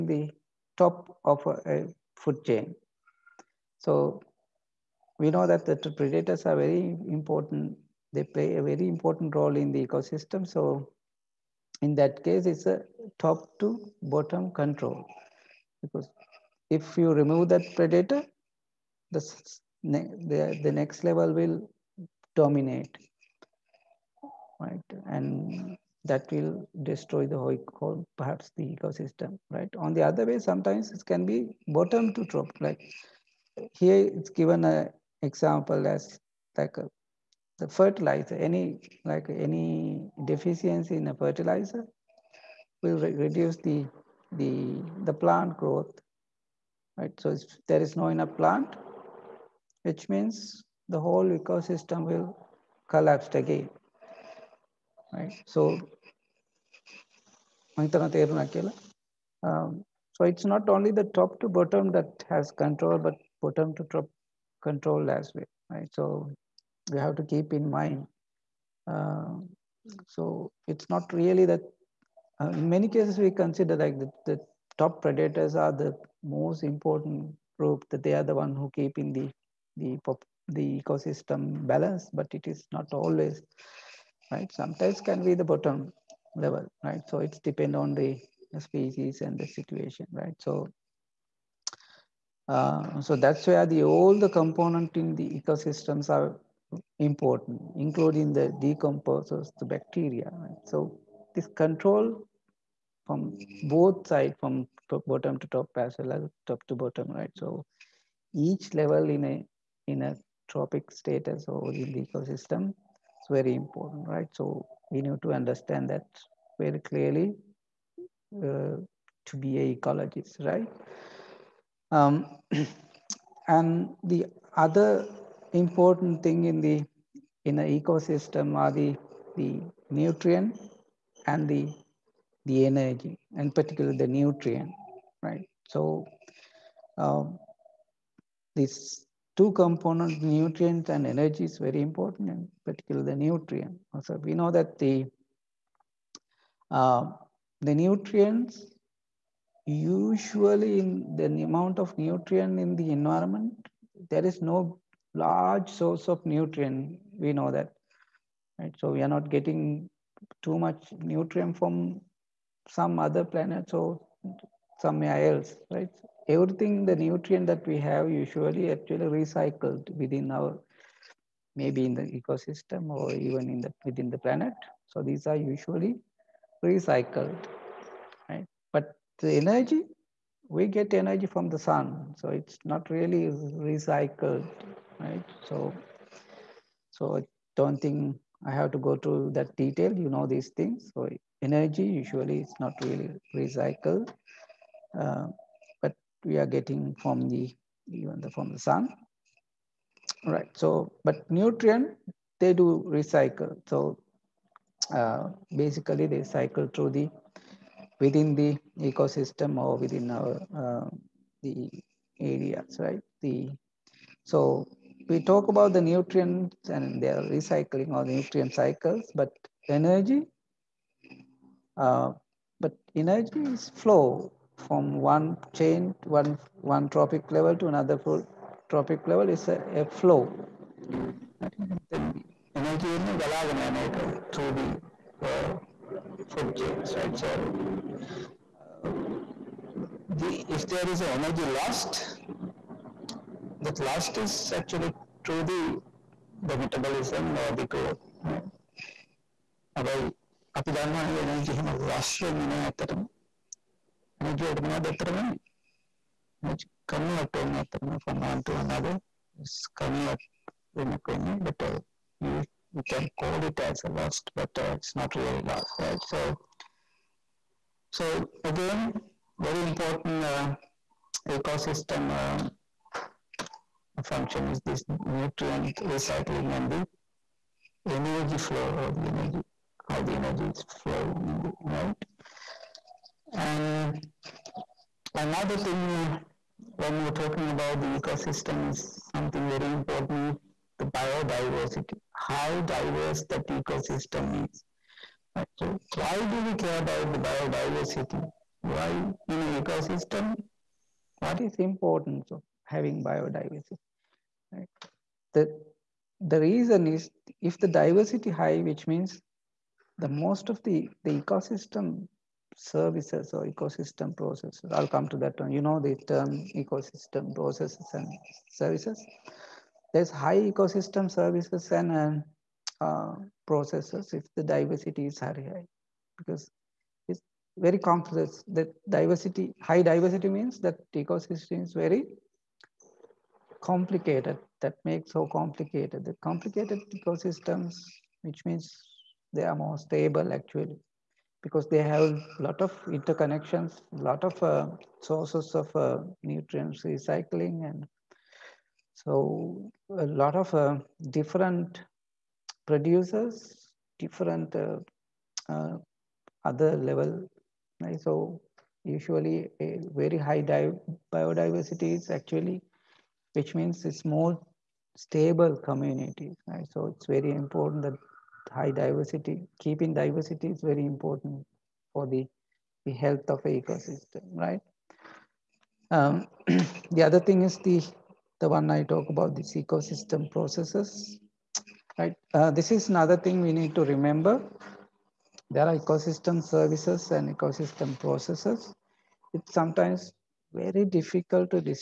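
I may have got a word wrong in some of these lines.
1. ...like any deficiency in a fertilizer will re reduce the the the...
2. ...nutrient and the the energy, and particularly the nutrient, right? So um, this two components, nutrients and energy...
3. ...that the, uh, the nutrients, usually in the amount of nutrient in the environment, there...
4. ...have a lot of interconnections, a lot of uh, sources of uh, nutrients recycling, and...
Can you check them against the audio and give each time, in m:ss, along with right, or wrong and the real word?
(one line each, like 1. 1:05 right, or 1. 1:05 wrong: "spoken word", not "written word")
1. 0:39 right
2. 2:09 right
3. 2:24 right
4. 5:41 right.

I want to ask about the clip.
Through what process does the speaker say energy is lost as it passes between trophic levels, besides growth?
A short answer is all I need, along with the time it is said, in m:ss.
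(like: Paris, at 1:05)
metabolism, at 4:06.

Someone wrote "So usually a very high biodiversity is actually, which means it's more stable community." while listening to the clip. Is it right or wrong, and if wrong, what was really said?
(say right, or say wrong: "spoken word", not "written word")
right.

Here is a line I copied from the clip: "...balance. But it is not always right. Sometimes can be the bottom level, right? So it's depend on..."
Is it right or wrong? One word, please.
right.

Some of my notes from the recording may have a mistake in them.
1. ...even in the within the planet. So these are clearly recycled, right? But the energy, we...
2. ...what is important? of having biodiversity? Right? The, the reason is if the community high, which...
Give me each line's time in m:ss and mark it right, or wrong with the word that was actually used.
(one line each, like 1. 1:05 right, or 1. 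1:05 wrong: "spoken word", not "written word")
1. 2:53 wrong: "usually", not "clearly"
2. 5:01 wrong: "diversity", not "community".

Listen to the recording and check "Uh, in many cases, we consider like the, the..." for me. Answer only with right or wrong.
right.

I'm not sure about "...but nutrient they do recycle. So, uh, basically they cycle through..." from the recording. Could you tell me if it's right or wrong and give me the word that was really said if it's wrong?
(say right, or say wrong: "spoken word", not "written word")
right.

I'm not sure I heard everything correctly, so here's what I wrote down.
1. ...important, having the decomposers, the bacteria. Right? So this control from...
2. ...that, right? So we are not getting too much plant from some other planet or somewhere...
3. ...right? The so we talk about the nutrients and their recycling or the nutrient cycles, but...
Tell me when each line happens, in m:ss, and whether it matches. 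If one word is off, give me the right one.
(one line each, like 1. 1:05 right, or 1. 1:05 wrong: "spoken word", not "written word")
1. 1:36 wrong: "including", not "having"
2. 2:37 wrong: "nutrient", not "plant"
3. 3:32 right.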